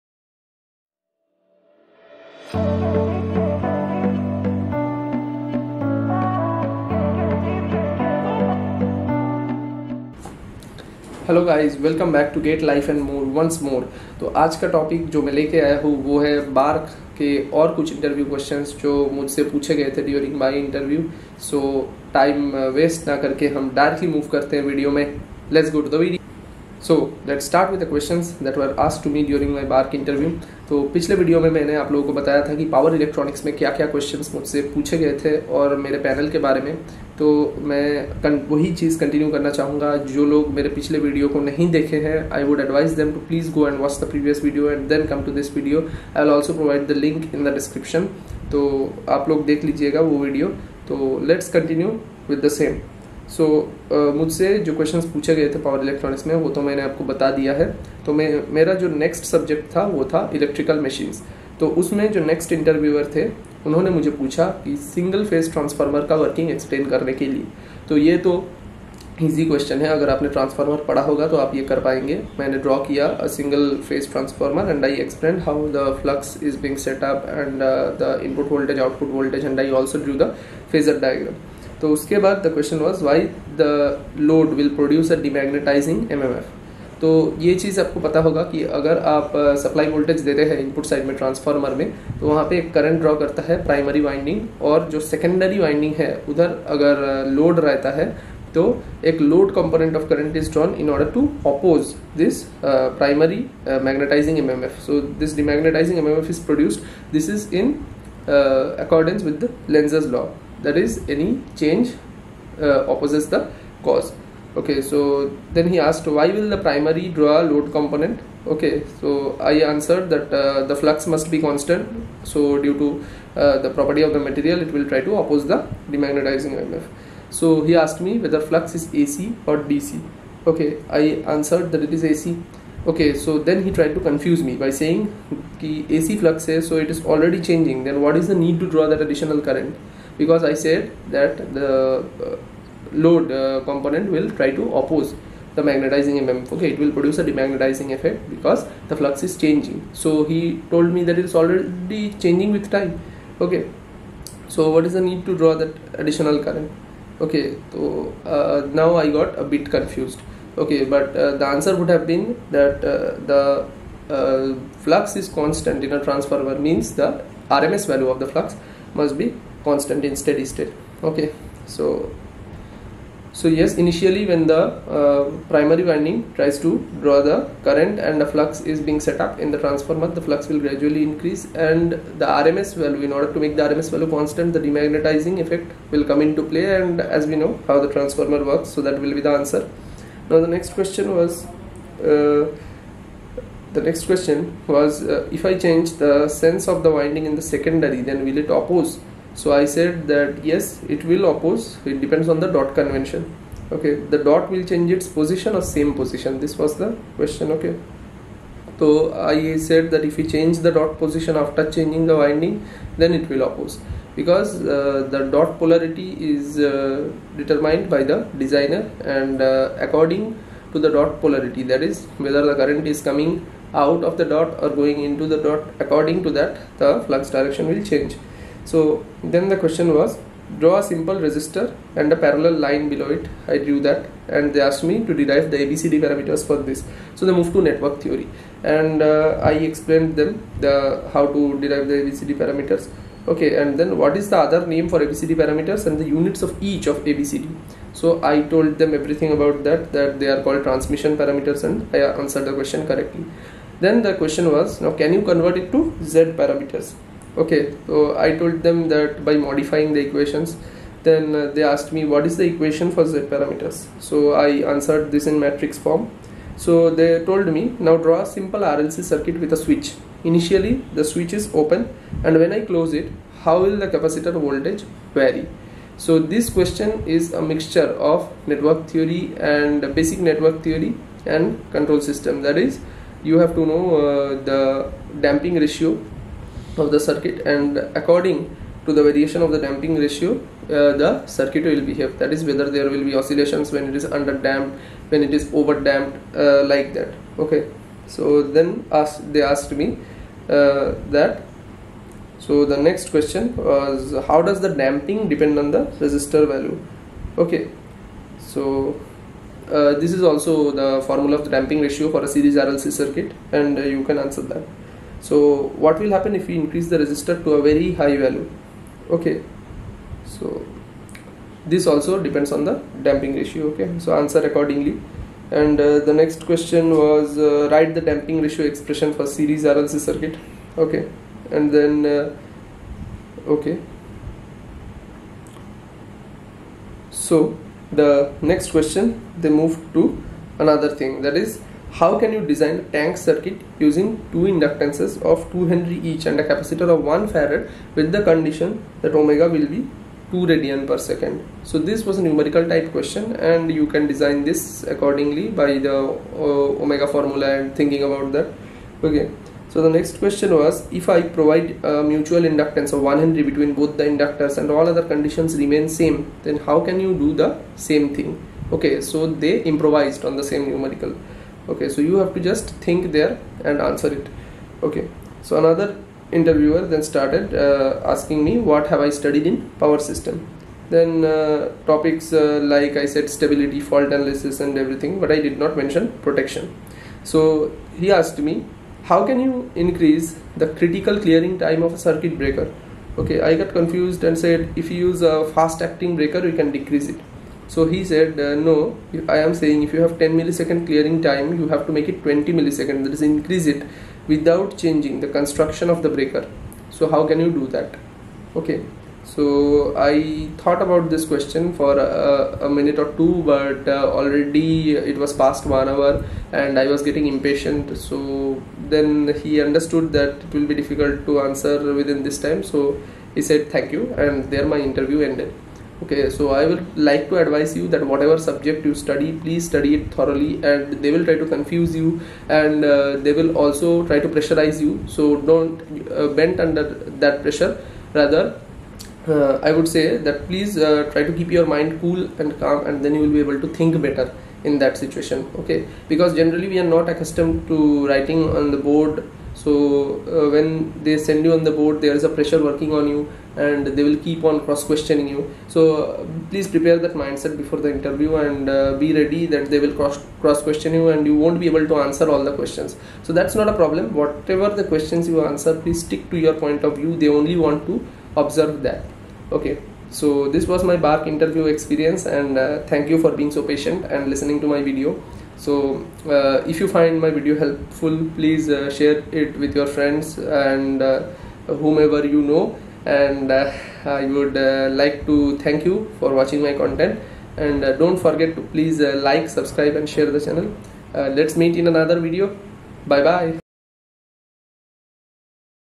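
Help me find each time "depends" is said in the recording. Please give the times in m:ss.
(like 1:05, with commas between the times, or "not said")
3:21, 5:05, 5:22.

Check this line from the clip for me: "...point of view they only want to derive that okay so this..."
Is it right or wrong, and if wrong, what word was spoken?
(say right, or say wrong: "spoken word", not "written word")
wrong: "observe", not "derive".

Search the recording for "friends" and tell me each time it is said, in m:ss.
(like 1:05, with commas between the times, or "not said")
7:59.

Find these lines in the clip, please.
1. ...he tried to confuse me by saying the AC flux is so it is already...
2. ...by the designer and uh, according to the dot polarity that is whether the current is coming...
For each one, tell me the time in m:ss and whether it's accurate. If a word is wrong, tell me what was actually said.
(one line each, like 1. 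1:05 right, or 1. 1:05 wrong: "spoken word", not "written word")
1. 2:13 right
2. 3:37 right.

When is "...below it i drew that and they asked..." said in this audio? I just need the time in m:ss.
3:52.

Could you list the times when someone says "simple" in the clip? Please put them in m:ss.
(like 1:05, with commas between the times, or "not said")
3:50, 4:28.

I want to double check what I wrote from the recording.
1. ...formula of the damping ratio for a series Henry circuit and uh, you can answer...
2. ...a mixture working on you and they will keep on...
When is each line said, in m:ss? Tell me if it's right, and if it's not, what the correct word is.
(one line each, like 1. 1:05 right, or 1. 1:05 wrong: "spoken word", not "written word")
1. 5:11 wrong: "RLC", not "Henry"
2. 7:32 wrong: "pressure", not "mixture".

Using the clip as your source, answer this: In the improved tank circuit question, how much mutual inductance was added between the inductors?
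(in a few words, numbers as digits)
1 henry.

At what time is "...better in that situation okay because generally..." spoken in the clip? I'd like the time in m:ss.
7:24.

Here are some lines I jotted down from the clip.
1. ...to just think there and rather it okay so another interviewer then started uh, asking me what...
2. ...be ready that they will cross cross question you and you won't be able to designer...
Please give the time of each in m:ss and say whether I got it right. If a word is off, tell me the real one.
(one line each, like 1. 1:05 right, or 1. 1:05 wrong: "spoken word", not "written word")
1. 6:12 wrong: "answer", not "rather"
2. 7:39 wrong: "answer", not "designer".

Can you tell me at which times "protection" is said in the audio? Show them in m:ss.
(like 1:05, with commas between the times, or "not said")
6:26.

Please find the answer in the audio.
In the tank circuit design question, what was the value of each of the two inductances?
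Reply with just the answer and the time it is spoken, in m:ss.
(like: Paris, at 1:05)
2 Henry, at 5:45.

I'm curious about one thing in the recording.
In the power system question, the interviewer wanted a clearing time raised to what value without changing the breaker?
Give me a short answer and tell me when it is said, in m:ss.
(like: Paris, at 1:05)
20 milliseconds, at 6:42.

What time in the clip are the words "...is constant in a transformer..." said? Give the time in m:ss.
2:45.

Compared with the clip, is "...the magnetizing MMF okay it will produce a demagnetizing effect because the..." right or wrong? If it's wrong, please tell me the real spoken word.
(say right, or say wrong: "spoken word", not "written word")
right.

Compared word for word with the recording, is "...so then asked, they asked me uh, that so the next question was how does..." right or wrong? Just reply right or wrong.
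right.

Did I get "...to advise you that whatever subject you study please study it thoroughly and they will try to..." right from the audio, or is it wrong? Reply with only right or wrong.
right.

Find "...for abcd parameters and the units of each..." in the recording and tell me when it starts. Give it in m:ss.
4:04.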